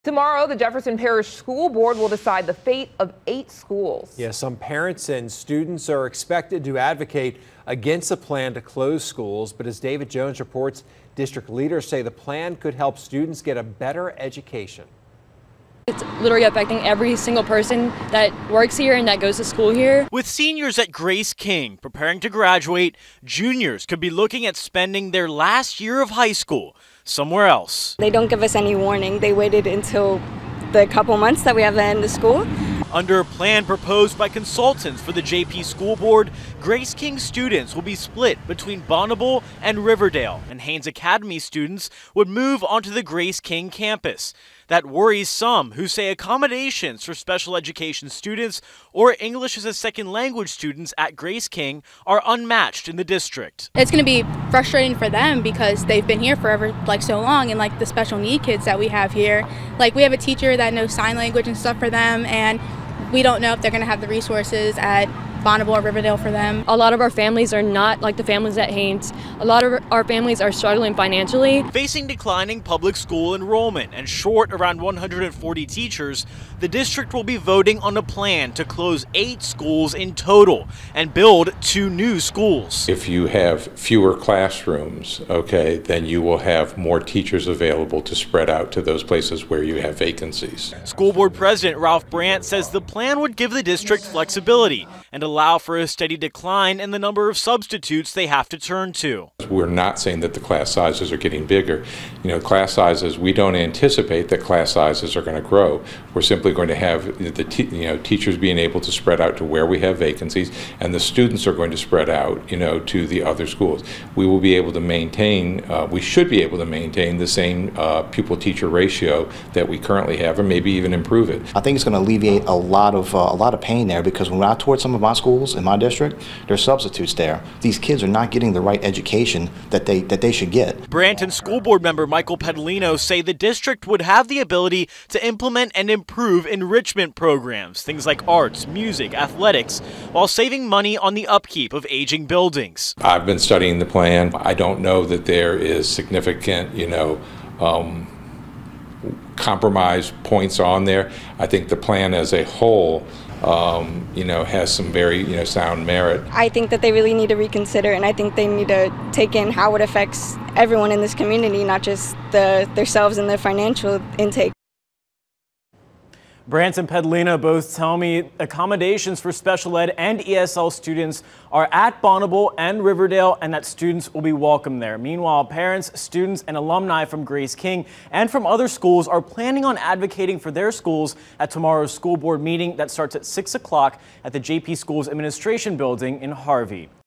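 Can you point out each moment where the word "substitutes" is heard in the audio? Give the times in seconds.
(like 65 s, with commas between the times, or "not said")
97 s, 126 s.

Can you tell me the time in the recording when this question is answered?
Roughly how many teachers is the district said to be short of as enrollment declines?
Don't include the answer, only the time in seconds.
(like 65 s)
74 s.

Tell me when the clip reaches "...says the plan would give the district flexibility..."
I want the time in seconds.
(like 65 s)
92 s.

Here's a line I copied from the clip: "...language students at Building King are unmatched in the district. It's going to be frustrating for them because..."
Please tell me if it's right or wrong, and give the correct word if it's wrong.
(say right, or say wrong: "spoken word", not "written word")
wrong: "Grace", not "Building".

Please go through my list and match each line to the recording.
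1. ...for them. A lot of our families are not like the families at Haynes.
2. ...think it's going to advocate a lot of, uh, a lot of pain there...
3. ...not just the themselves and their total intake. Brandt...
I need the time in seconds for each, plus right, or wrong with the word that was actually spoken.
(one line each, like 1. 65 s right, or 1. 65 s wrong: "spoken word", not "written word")
1. 66 s right
2. 121 s wrong: "alleviate", not "advocate"
3. 161 s wrong: "financial", not "total".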